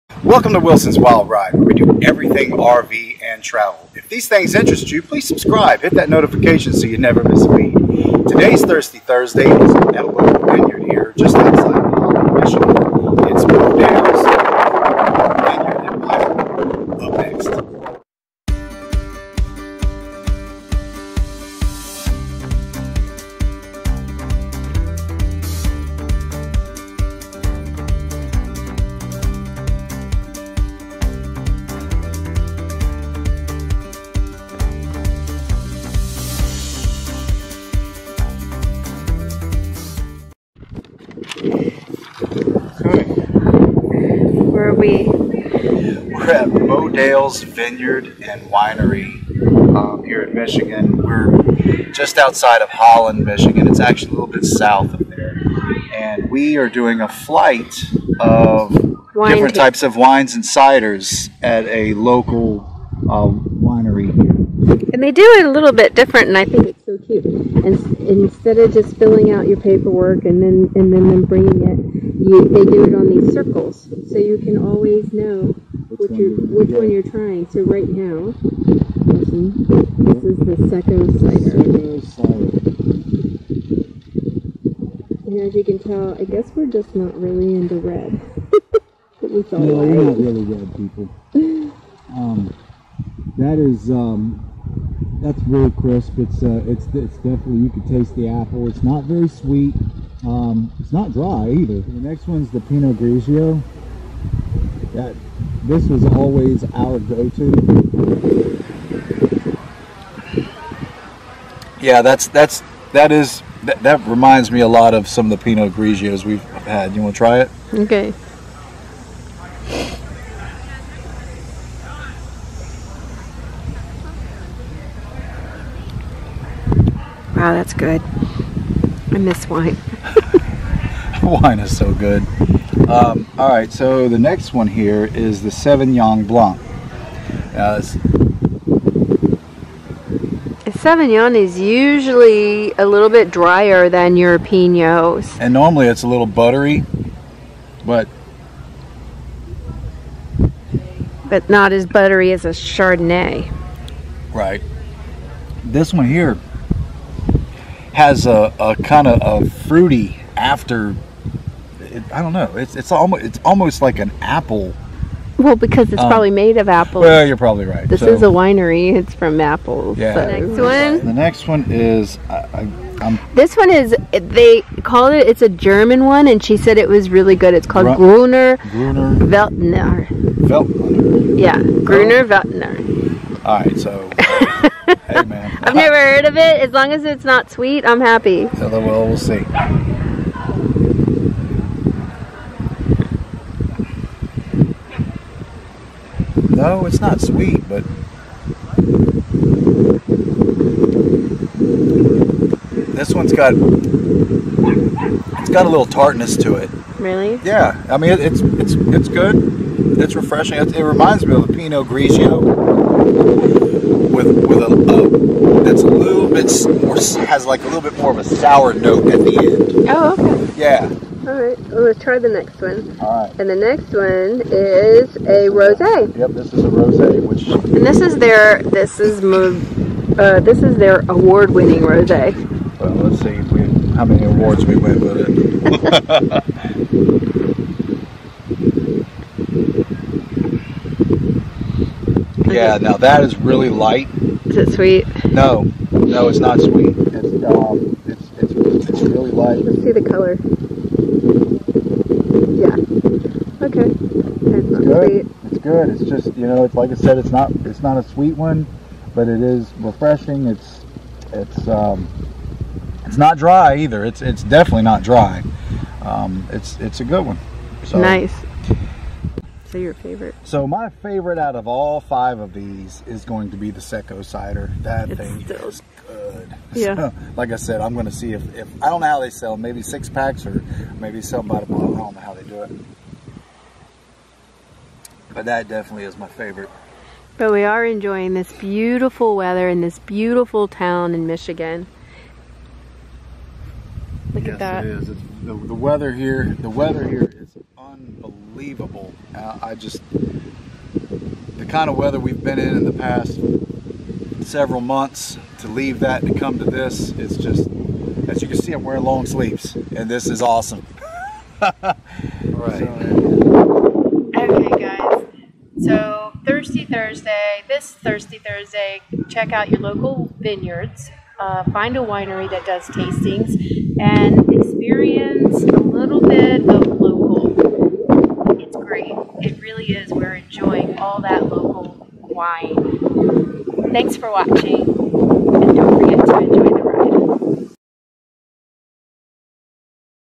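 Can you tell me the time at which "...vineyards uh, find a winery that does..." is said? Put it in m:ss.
5:20.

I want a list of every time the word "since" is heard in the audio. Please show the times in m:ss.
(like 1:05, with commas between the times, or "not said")
not said.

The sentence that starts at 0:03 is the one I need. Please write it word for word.
If these things interest you, please subscribe, hit that notification so you never miss a beat.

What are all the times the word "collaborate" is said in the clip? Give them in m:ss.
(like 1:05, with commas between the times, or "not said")
not said.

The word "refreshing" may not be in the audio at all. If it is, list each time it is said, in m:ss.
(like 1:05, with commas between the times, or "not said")
3:30, 4:19.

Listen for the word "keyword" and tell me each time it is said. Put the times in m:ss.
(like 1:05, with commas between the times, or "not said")
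not said.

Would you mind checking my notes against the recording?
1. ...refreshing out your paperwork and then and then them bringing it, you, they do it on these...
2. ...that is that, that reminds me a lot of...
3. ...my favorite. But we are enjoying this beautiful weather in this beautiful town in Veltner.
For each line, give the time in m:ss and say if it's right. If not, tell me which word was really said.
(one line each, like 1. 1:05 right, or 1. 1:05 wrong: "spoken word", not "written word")
1. 1:08 wrong: "filling", not "refreshing"
2. 1:52 right
3. 4:46 wrong: "Michigan", not "Veltner".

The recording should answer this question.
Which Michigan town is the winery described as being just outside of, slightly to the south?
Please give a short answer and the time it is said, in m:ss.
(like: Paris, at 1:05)
Holland, at 0:52.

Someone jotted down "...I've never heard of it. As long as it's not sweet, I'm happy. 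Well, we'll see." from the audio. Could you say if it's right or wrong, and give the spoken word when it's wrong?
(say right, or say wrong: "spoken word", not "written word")
right.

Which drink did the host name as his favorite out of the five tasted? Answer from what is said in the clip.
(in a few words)
Secco cider.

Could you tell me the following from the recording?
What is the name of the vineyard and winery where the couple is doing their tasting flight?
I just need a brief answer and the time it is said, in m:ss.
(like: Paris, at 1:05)
Modales Vineyard and Winery, at 0:46.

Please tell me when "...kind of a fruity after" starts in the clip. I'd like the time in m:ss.
2:38.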